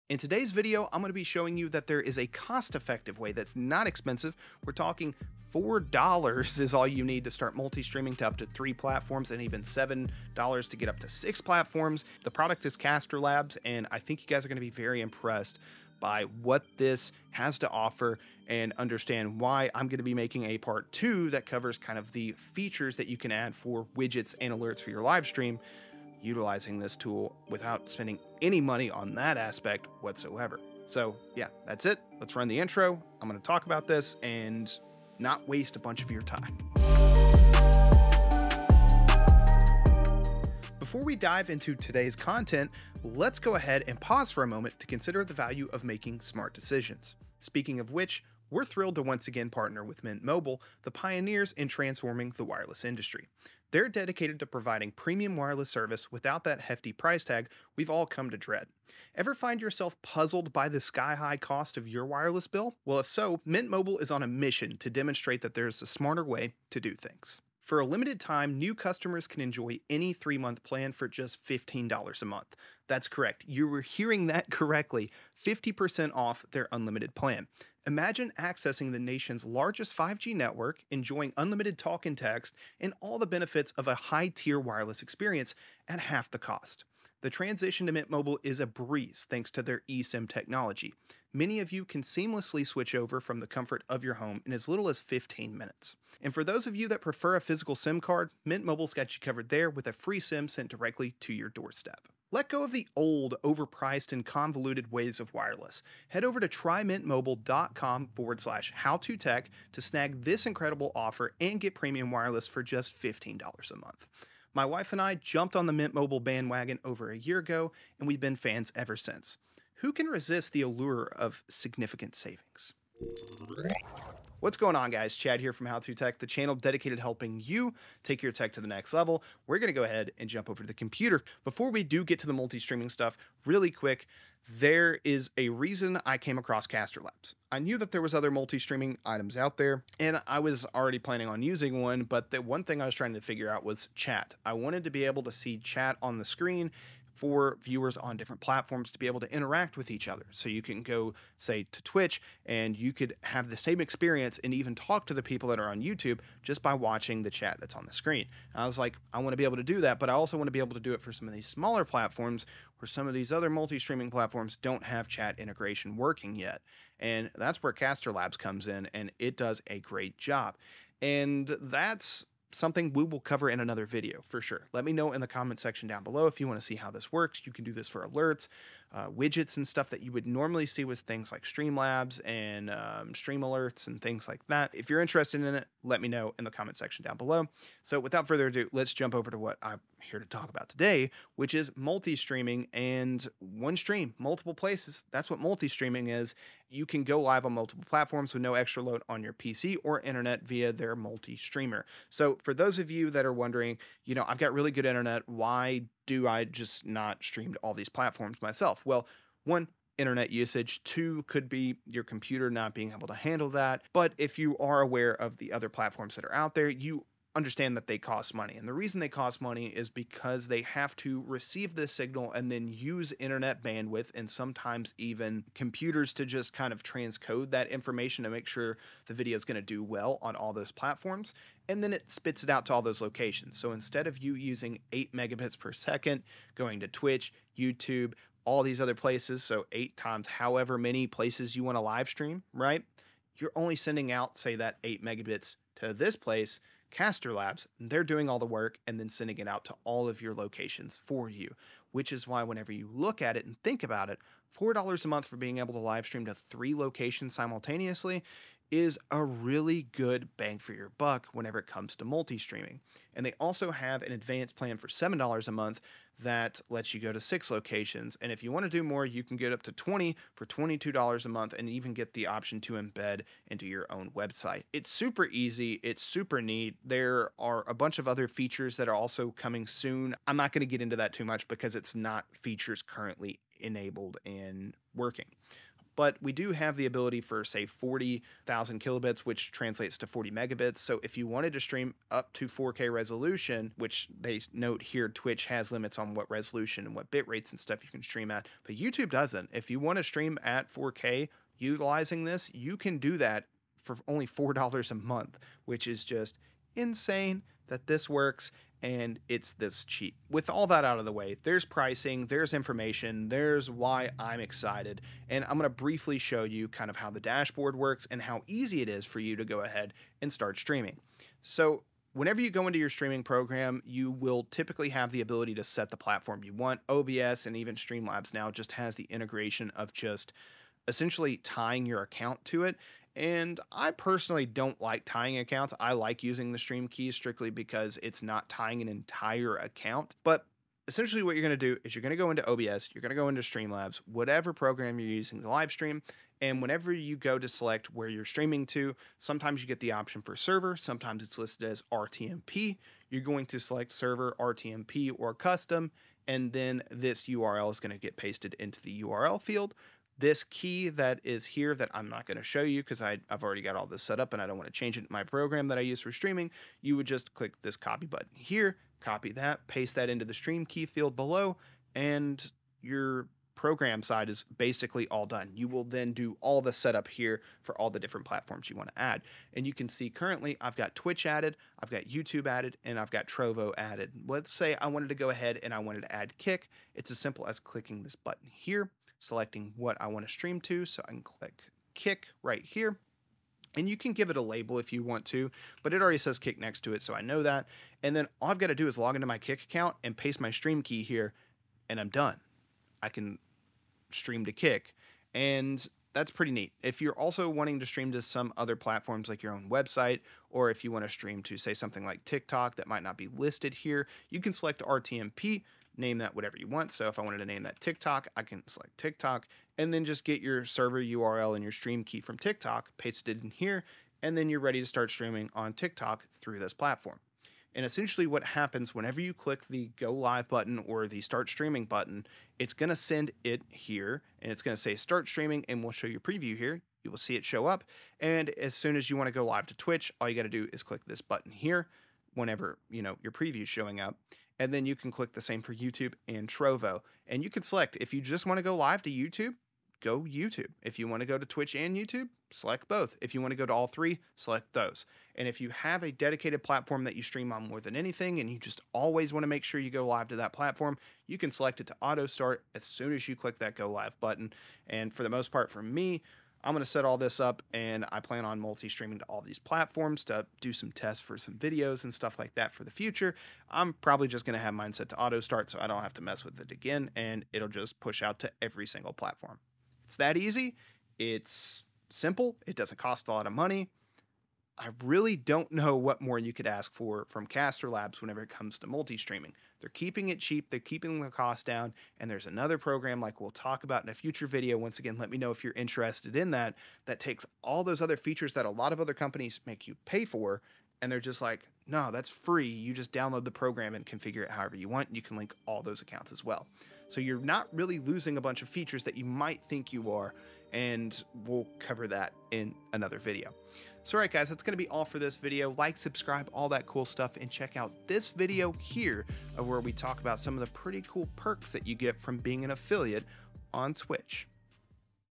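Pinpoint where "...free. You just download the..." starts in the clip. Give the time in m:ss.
8:22.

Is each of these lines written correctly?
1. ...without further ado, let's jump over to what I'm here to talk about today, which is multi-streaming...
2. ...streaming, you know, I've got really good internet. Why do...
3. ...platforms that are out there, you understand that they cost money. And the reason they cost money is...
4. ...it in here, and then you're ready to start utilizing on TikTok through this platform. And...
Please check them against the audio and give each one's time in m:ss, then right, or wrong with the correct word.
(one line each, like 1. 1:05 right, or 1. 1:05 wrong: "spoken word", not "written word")
1. 3:07 right
2. 3:23 wrong: "wondering", not "streaming"
3. 3:35 right
4. 7:03 wrong: "streaming", not "utilizing".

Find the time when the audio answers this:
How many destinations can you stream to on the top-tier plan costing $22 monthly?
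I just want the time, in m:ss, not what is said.
4:29.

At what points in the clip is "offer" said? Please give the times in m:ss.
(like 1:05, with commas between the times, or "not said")
0:17, 1:50.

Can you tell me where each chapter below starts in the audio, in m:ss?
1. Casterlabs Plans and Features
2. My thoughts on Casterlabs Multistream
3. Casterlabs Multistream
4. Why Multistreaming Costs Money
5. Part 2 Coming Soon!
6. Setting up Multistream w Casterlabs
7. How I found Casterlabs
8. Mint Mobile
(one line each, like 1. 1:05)
1. 4:20
2. 8:01
3. 3:11
4. 3:38
5. 2:50
6. 5:15
7. 2:10
8. 0:40.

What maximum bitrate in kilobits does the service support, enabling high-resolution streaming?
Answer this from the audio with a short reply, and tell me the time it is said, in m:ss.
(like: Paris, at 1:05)
40,000 kilobits, at 4:47.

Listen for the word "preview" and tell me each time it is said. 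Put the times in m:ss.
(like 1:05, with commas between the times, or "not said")
7:16, 7:23.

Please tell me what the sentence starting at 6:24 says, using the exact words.
Let's say I wanted to go ahead and I wanted to add Kick.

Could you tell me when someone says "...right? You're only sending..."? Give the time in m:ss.
4:02.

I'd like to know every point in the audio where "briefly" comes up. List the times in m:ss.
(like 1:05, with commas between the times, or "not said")
5:15.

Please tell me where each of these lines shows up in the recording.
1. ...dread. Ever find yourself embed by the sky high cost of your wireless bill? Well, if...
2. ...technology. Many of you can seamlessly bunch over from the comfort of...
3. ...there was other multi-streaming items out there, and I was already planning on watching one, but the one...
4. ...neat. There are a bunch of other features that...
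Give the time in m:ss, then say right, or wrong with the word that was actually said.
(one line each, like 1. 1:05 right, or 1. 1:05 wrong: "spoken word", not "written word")
1. 0:58 wrong: "puzzled", not "embed"
2. 1:30 wrong: "switch", not "bunch"
3. 2:17 wrong: "using", not "watching"
4. 4:36 right.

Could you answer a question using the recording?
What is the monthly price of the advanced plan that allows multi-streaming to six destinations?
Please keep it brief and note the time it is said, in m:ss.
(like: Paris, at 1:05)
$7, at 4:24.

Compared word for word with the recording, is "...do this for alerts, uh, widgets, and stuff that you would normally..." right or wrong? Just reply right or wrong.
right.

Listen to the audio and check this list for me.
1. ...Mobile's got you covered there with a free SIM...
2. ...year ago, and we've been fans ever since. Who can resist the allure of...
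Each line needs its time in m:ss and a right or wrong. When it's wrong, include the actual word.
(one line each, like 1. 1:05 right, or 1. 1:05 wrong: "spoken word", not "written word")
1. 1:38 right
2. 1:57 right.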